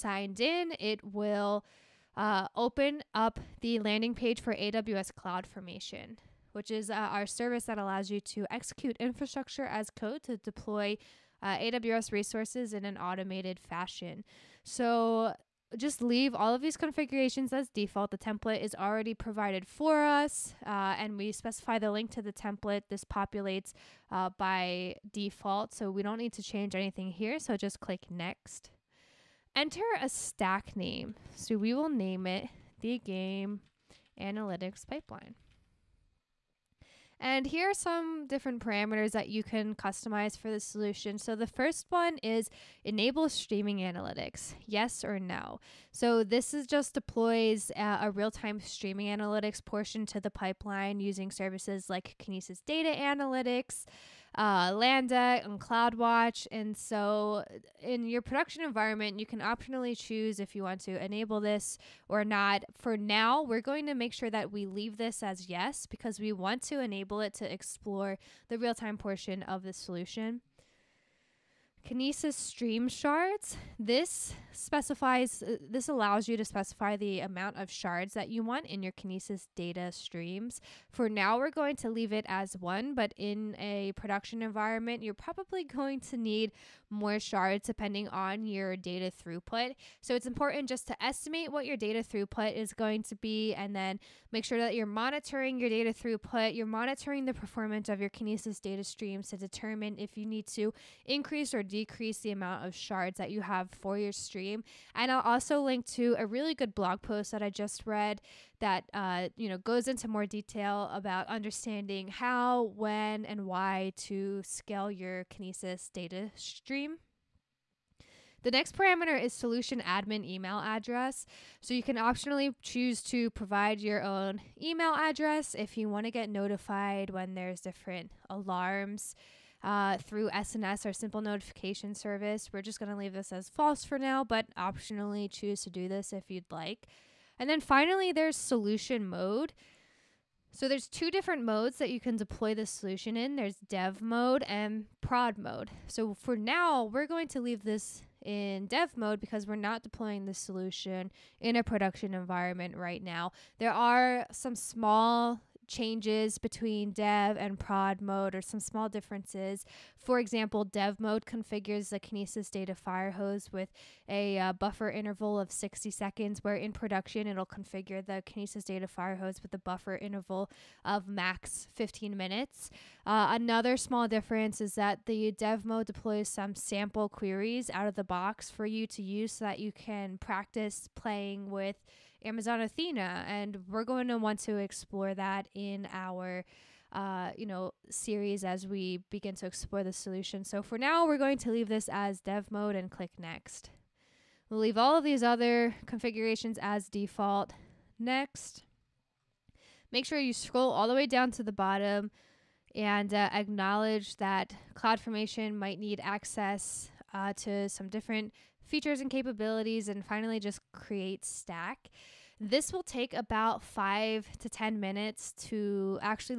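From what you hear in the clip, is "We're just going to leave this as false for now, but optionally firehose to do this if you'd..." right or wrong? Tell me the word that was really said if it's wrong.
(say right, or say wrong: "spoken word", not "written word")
wrong: "choose", not "firehose".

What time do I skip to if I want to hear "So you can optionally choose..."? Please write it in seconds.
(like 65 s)
121 s.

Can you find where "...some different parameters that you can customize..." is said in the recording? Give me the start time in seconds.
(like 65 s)
37 s.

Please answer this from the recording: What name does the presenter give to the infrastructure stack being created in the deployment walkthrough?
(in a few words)
Game Analytics Pipeline.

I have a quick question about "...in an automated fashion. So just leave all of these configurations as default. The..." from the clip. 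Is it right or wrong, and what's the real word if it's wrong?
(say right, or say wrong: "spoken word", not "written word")
right.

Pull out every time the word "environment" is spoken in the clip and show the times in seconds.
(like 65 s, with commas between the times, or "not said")
58 s, 84 s, 152 s.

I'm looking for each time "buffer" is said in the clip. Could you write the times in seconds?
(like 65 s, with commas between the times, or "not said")
164 s, 169 s.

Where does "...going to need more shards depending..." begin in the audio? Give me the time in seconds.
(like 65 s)
85 s.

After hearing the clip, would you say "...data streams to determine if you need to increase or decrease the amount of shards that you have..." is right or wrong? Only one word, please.
right.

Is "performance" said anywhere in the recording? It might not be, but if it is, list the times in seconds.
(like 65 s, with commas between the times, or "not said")
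97 s.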